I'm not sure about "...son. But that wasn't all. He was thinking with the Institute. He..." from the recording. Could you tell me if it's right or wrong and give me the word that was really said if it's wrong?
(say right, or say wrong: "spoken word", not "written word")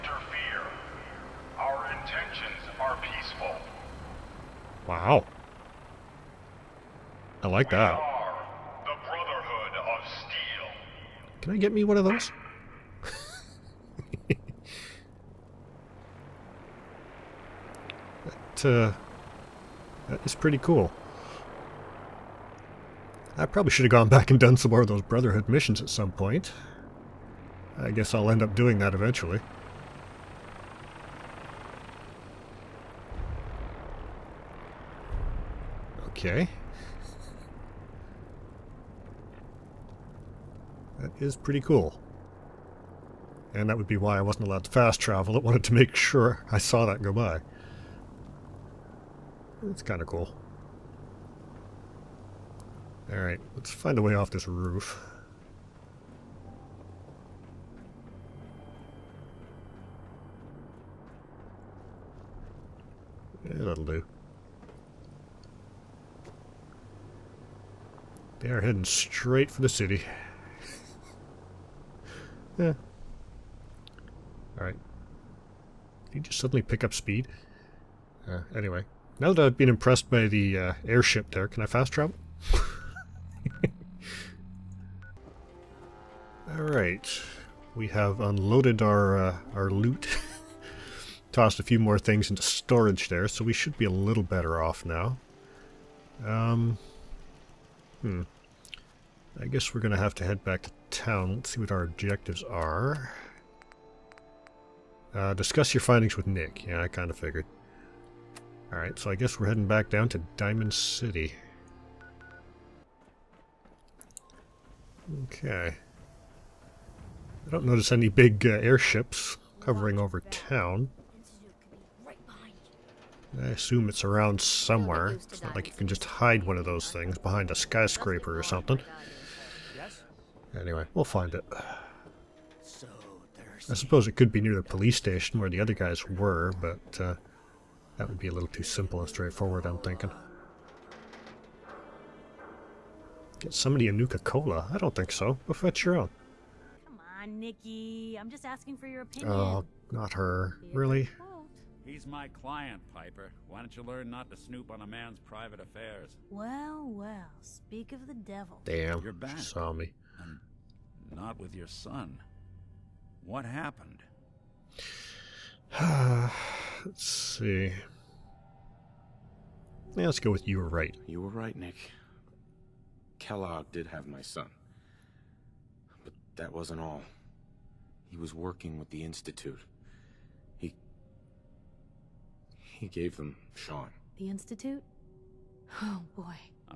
wrong: "working", not "thinking".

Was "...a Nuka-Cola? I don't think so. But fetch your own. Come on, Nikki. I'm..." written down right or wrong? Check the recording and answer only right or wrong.
right.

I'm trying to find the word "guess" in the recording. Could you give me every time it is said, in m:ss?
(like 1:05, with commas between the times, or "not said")
0:27, 1:39, 1:49.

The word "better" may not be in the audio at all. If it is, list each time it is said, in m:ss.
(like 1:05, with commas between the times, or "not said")
1:34.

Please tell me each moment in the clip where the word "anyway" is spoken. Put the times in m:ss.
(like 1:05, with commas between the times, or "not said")
1:18, 2:10.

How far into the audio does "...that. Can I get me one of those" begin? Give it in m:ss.
0:07.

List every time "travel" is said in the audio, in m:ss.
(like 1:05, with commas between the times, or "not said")
0:45, 1:21.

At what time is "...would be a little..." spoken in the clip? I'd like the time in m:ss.
2:18.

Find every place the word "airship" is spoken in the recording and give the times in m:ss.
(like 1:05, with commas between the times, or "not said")
1:20, 1:58.